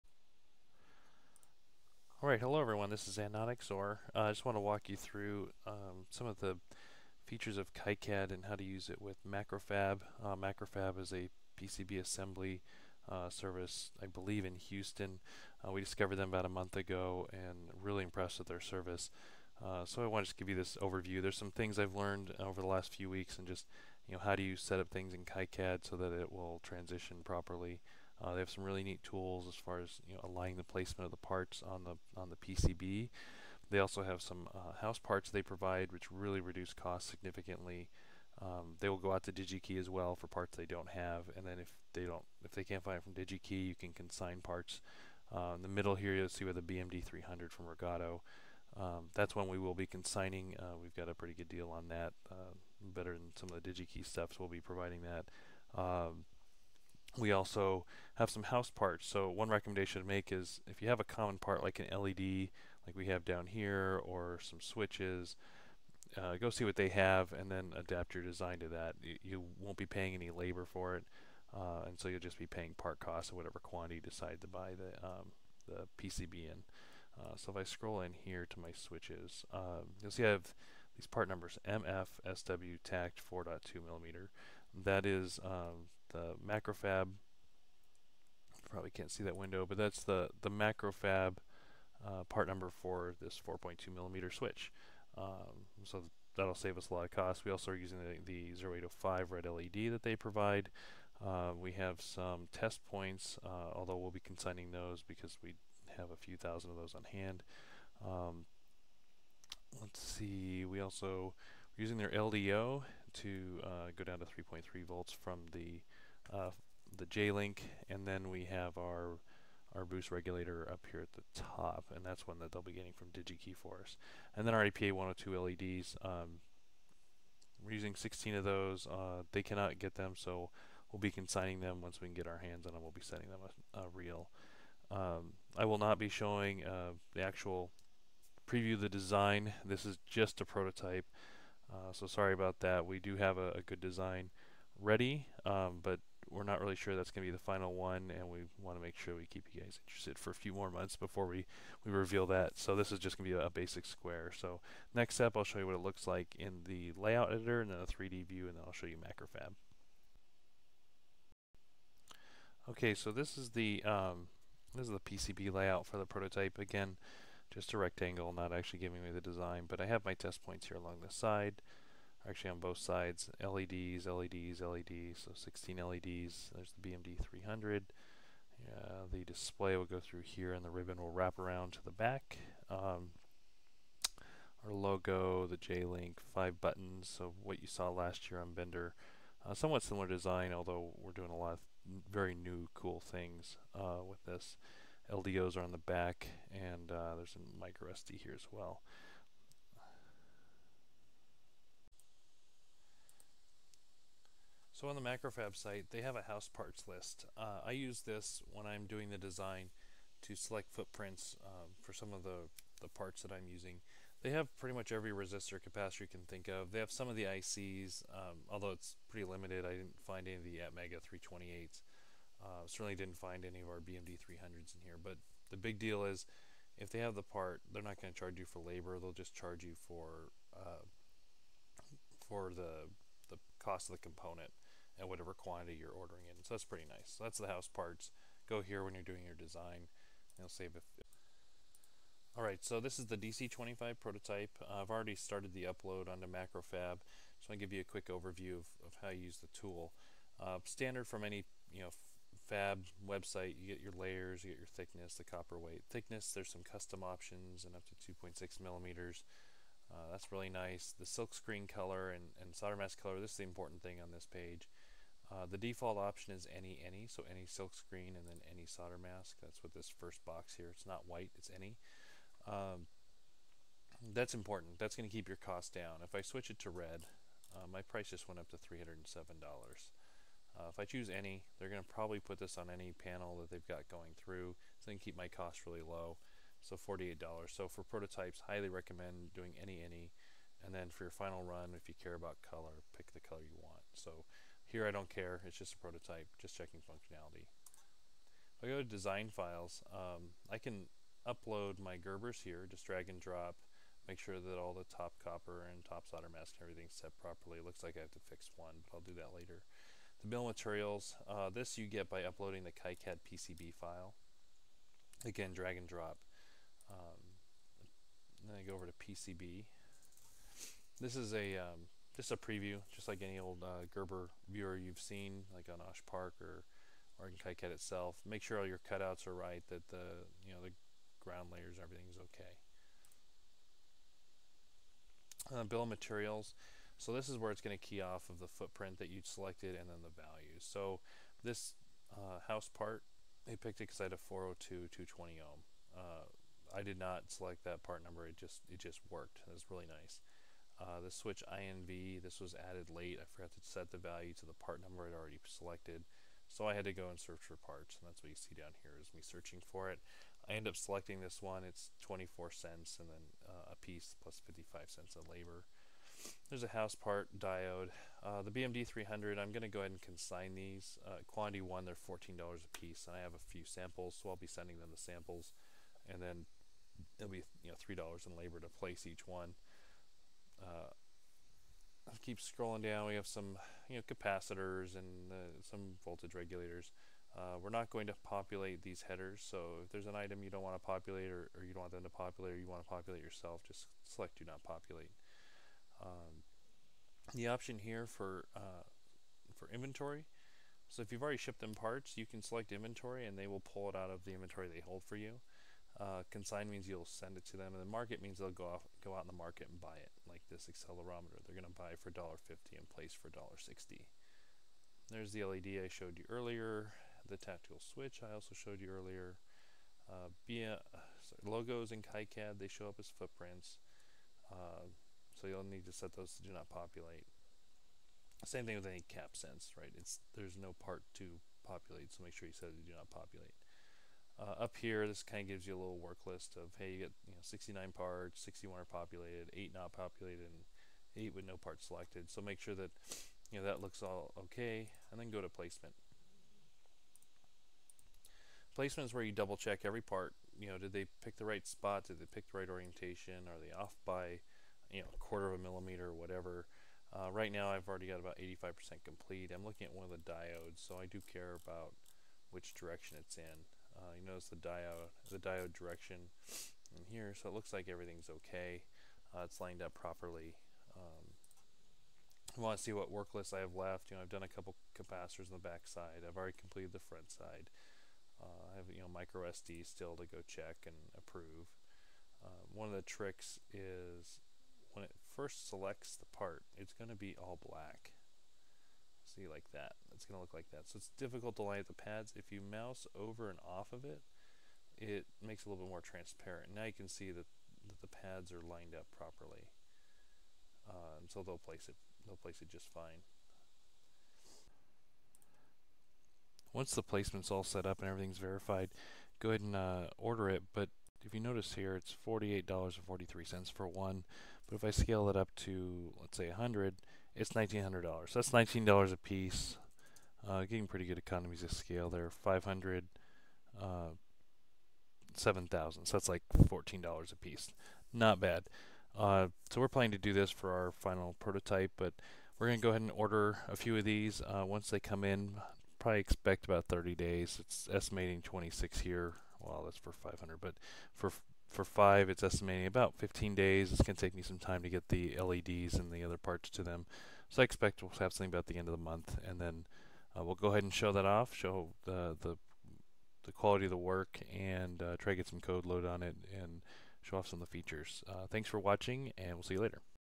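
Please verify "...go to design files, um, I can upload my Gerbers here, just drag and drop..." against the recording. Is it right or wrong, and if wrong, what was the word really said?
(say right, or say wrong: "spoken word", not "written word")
right.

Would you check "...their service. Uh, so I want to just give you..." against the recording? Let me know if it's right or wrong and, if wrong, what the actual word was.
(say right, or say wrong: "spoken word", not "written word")
right.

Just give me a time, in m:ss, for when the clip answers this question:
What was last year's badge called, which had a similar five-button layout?
3:08.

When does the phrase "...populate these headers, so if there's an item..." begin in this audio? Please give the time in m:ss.
6:28.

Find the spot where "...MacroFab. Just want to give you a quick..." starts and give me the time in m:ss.
4:06.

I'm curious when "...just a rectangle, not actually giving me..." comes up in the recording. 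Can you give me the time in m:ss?
2:47.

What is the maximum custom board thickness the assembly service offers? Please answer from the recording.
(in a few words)
2.6 millimeters.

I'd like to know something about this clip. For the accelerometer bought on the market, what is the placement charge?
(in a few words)
$1.60.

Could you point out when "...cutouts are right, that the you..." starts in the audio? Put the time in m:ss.
5:28.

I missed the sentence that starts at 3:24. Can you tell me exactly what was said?
So on the MacroFab site, they have a house parts list.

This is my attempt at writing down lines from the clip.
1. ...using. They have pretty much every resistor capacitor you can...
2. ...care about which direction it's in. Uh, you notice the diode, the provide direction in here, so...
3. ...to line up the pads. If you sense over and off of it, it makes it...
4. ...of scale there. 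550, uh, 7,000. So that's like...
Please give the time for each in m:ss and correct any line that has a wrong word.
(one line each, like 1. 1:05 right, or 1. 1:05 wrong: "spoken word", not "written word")
1. 3:33 right
2. 7:41 wrong: "diode", not "provide"
3. 8:11 wrong: "mouse", not "sense"
4. 8:41 wrong: "500", not "550".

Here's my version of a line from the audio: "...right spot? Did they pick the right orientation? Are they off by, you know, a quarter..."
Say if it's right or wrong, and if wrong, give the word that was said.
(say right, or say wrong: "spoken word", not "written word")
right.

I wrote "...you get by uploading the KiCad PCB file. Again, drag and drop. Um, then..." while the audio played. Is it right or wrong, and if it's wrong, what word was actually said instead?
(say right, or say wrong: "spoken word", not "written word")
right.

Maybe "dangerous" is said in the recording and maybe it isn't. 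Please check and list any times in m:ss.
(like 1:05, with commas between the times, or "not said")
not said.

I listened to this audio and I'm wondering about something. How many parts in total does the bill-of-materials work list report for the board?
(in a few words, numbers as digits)
69.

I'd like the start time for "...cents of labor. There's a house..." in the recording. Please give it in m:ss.
6:04.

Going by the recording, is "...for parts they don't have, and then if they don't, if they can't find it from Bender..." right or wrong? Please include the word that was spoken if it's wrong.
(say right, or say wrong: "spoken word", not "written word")
wrong: "DigiKey", not "Bender".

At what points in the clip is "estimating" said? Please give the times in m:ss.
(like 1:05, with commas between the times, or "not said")
8:57, 9:02.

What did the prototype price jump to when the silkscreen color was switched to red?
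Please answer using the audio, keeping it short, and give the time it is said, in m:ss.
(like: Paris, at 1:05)
$307, at 4:38.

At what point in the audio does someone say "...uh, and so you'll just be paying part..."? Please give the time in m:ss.
1:11.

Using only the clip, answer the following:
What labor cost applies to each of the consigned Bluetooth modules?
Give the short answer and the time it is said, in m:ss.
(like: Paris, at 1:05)
$3, at 6:17.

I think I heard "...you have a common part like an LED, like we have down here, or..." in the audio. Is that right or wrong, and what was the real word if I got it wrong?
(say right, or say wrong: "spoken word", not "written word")
right.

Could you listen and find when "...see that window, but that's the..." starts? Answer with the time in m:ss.
1:29.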